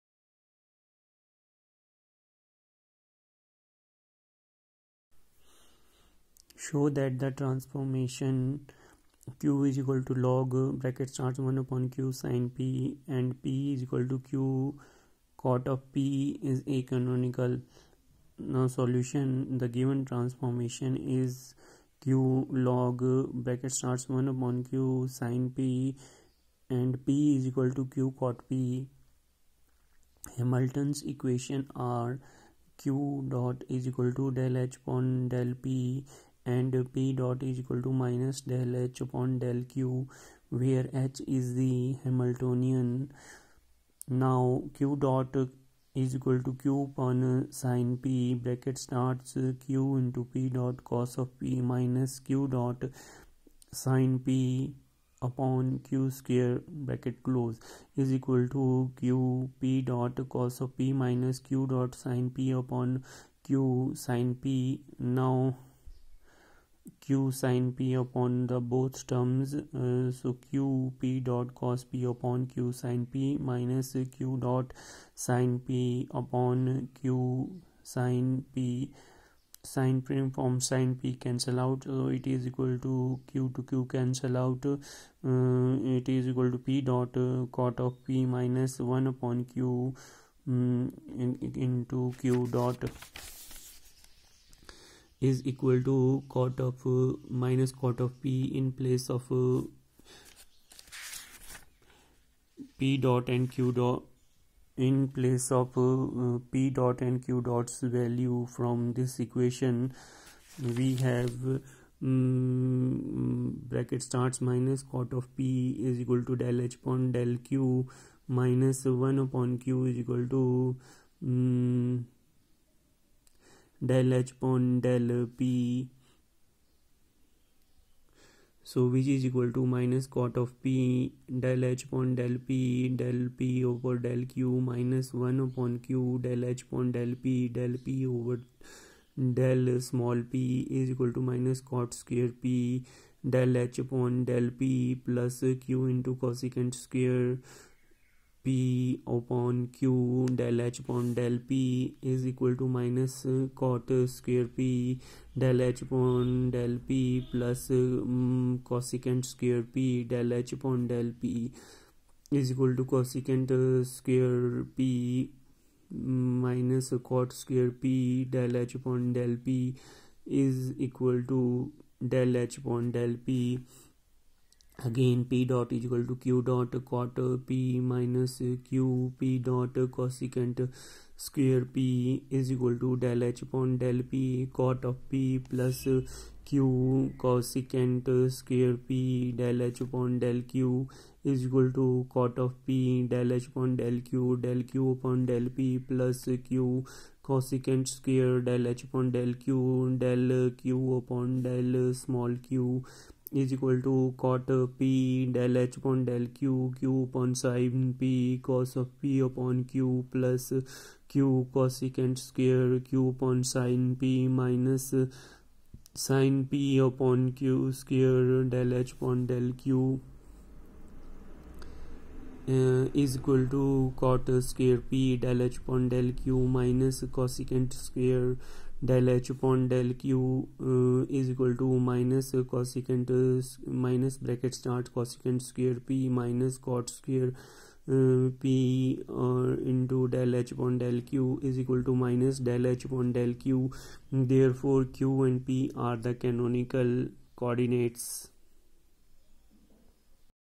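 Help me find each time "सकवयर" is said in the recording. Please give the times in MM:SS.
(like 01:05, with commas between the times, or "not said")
03:01, 03:08, 03:17.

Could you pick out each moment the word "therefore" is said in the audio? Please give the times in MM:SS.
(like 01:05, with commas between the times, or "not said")
04:04.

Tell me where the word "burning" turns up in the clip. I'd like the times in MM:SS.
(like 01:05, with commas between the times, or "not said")
not said.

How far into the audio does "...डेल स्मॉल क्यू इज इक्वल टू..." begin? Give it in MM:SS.
03:21.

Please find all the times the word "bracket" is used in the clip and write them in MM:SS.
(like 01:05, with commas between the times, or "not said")
00:10, 00:23, 00:48, 00:56, 01:53, 03:54.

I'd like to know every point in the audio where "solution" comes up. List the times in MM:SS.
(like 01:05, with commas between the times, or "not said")
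00:18.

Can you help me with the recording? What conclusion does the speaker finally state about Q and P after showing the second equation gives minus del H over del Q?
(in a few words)
canonical coordinates.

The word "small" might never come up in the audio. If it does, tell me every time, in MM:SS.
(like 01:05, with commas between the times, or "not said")
02:19.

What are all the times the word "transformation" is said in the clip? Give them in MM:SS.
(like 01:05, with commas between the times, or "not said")
00:07, 00:20.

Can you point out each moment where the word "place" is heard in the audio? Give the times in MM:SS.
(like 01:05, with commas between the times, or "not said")
01:38, 01:45.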